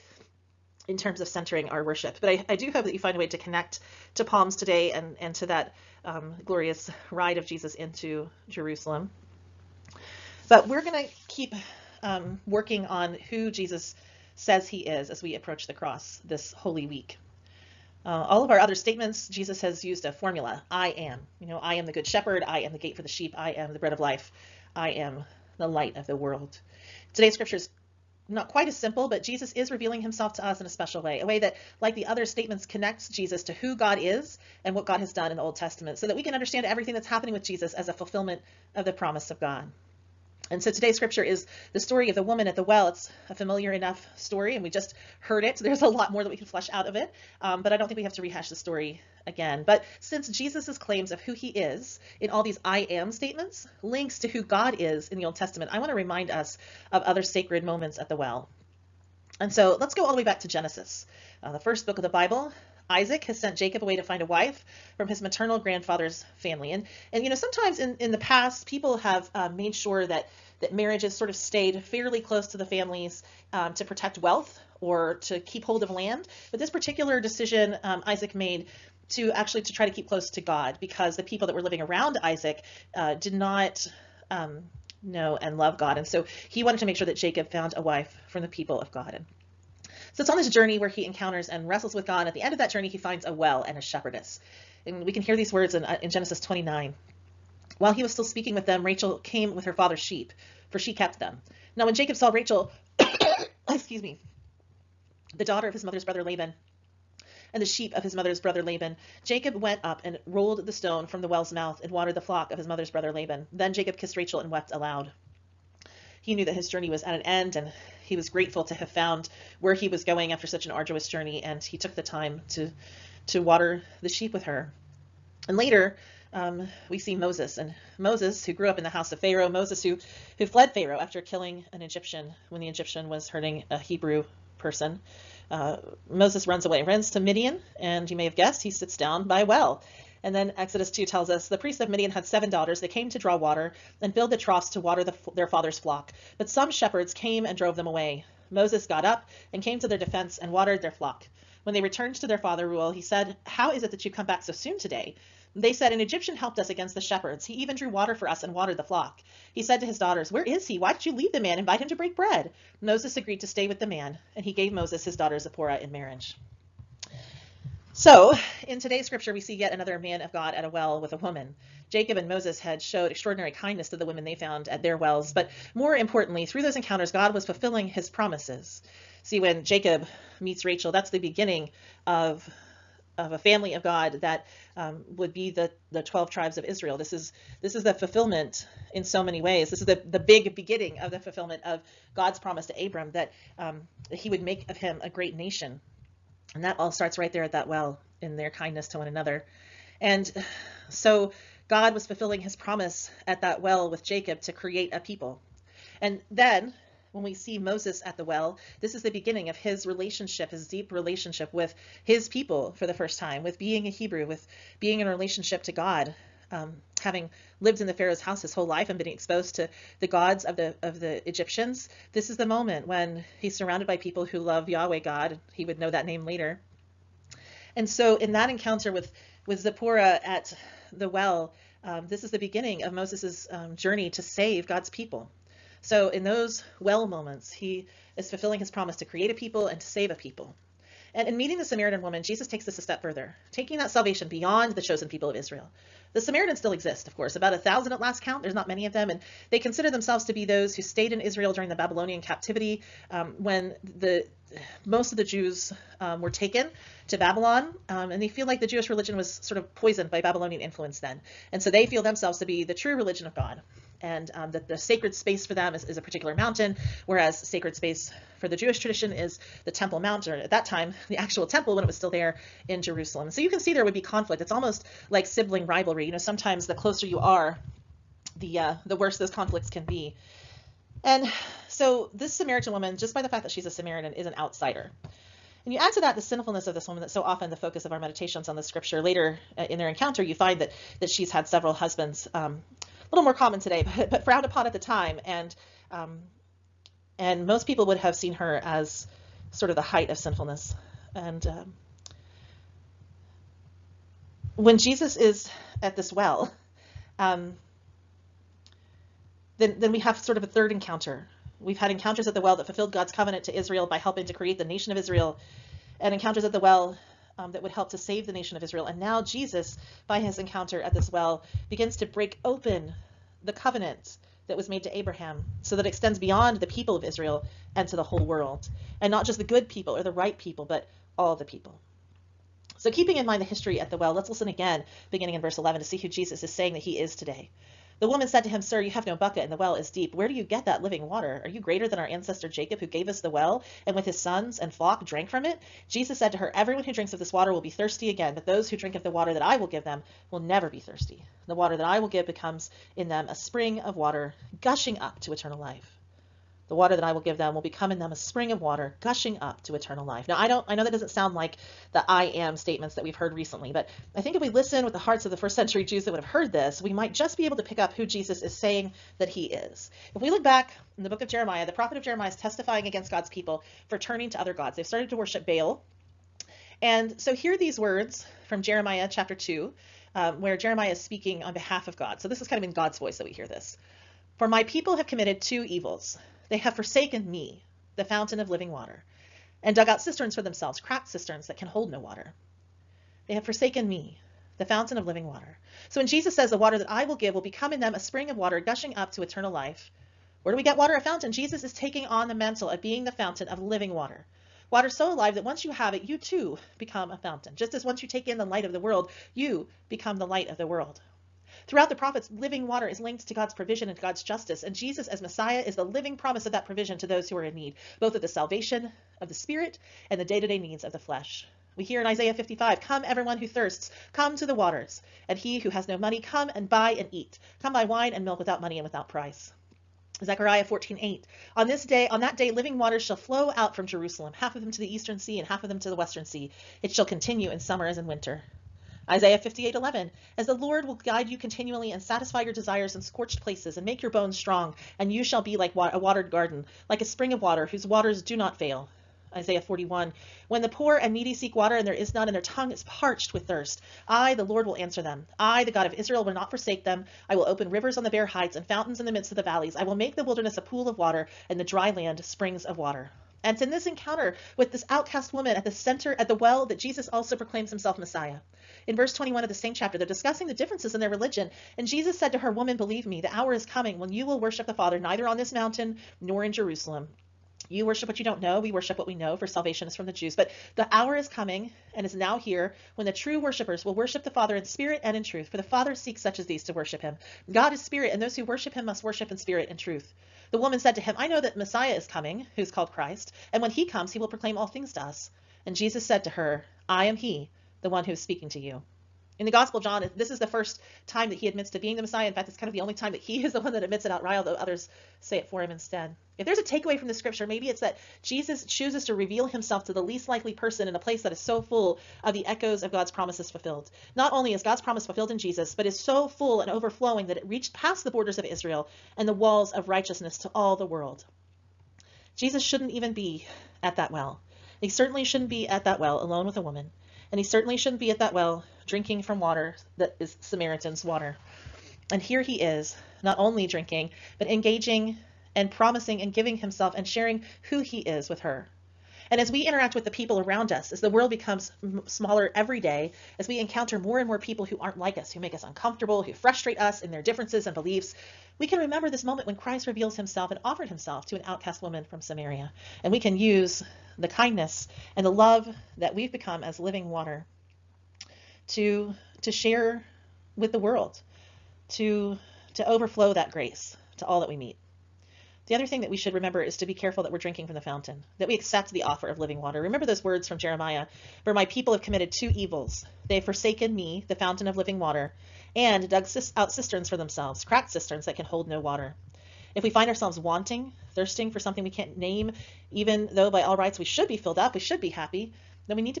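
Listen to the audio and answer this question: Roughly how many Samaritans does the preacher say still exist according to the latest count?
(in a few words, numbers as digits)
About 1,000.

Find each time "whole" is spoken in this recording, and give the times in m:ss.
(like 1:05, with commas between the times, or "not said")
3:38, 5:28.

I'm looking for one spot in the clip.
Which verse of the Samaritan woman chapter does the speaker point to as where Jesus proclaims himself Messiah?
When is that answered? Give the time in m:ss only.
7:48.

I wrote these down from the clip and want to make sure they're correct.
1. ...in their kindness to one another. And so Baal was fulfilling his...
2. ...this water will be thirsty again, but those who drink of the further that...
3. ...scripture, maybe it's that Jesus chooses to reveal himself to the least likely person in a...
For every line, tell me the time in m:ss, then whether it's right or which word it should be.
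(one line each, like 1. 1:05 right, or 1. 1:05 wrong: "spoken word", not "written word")
1. 3:18 wrong: "God", not "Baal"
2. 5:47 wrong: "water", not "further"
3. 8:27 right.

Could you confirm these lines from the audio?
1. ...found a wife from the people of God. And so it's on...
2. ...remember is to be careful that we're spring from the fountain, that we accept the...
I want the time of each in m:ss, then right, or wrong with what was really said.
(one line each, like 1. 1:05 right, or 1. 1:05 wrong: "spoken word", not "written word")
1. 1:27 right
2. 9:26 wrong: "drinking", not "spring".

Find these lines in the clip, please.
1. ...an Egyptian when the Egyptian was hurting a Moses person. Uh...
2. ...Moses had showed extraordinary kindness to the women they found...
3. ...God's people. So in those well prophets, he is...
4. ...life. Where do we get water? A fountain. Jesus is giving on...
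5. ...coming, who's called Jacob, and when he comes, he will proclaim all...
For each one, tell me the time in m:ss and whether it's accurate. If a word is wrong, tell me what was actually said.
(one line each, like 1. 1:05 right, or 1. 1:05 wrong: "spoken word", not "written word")
1. 2:11 wrong: "Hebrew", not "Moses"
2. 2:52 right
3. 3:54 wrong: "moments", not "prophets"
4. 6:39 wrong: "taking", not "giving"
5. 8:12 wrong: "Christ", not "Jacob".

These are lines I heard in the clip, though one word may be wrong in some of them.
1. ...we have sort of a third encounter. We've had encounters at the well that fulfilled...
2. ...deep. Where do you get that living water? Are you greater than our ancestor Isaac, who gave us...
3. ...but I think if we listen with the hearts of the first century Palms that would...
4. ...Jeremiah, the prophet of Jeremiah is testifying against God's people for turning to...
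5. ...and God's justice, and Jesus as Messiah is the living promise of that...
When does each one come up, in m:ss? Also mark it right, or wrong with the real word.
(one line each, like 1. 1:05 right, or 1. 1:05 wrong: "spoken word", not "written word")
1. 5:09 right
2. 5:39 wrong: "Jacob", not "Isaac"
3. 6:03 wrong: "Jews", not "Palms"
4. 6:11 right
5. 6:53 right.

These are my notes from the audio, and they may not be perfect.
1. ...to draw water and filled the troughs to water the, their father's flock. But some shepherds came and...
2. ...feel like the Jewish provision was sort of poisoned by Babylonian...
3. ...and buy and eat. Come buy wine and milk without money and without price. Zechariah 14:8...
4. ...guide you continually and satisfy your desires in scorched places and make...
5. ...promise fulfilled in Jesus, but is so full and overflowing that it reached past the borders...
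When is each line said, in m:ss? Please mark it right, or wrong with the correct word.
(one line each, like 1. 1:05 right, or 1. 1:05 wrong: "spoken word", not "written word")
1. 2:23 right
2. 4:18 wrong: "religion", not "provision"
3. 7:06 right
4. 7:21 right
5. 8:34 right.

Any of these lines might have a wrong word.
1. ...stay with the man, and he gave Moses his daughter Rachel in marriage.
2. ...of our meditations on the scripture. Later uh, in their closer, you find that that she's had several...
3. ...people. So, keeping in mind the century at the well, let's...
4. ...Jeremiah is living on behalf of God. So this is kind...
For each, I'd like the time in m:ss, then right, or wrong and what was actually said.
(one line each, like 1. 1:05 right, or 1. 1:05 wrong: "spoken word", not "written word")
1. 2:43 wrong: "Zipporah", not "Rachel"
2. 4:47 wrong: "encounter", not "closer"
3. 5:31 wrong: "history", not "century"
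4. 6:20 wrong: "speaking", not "living".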